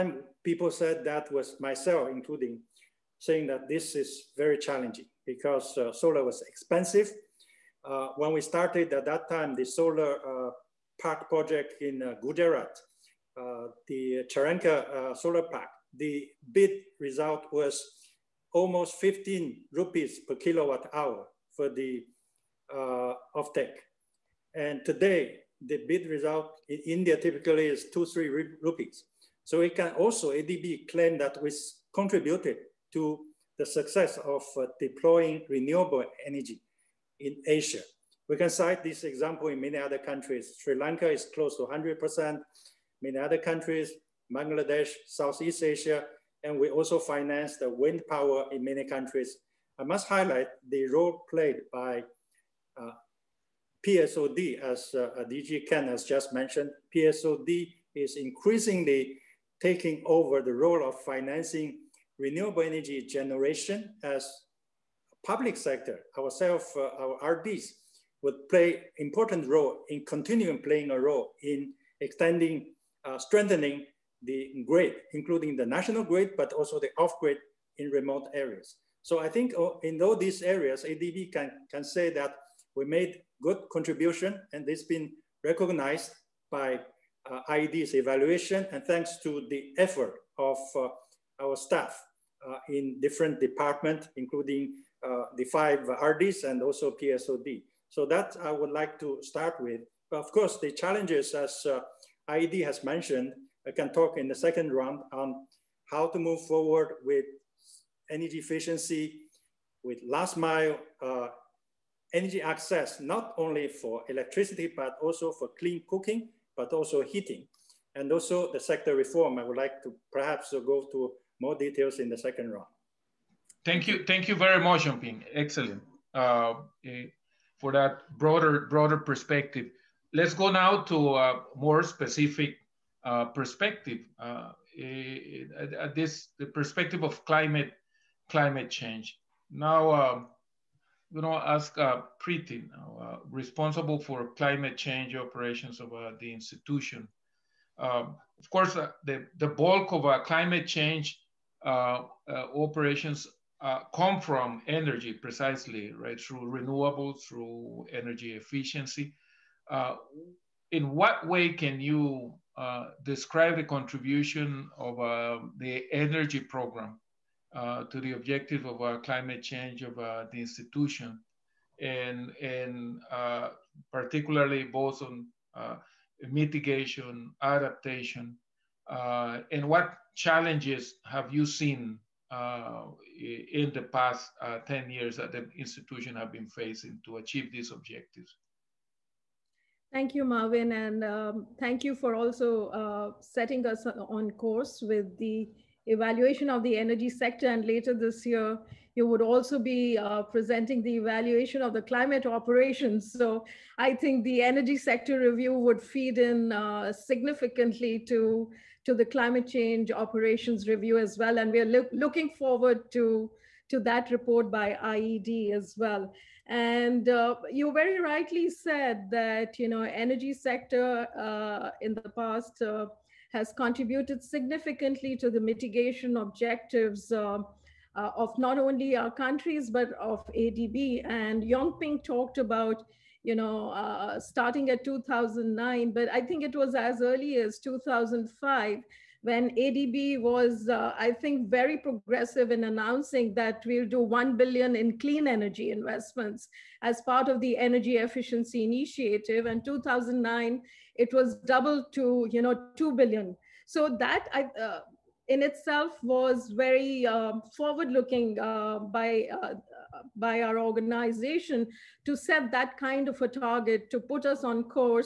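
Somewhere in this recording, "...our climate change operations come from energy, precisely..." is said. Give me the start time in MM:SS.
02:30.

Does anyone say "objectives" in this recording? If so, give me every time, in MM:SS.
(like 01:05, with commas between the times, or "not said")
02:48, 03:07, 03:46.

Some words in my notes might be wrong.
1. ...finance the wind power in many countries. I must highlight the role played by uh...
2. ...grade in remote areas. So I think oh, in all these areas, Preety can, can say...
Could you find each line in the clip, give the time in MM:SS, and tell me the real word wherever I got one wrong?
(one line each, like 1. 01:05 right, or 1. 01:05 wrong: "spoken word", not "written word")
1. 00:46 right
2. 01:17 wrong: "ADB", not "Preety".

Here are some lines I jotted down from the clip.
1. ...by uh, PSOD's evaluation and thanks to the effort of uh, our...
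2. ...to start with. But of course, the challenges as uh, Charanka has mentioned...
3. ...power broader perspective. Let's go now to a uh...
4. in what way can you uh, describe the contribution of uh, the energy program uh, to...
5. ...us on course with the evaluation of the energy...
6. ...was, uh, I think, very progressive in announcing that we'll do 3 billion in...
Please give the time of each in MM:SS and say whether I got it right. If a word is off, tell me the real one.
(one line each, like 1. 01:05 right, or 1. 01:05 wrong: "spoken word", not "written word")
1. 01:26 wrong: "IED", not "PSOD"
2. 01:39 wrong: "IED", not "Charanka"
3. 02:08 wrong: "broader", not "power"
4. 02:40 right
5. 03:13 right
6. 04:00 wrong: "1", not "3".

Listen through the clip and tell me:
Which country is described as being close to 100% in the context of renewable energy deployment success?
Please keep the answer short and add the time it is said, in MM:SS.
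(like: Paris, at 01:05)
Sri Lanka, at 00:40.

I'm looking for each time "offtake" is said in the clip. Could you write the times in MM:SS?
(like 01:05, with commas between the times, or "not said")
00:23.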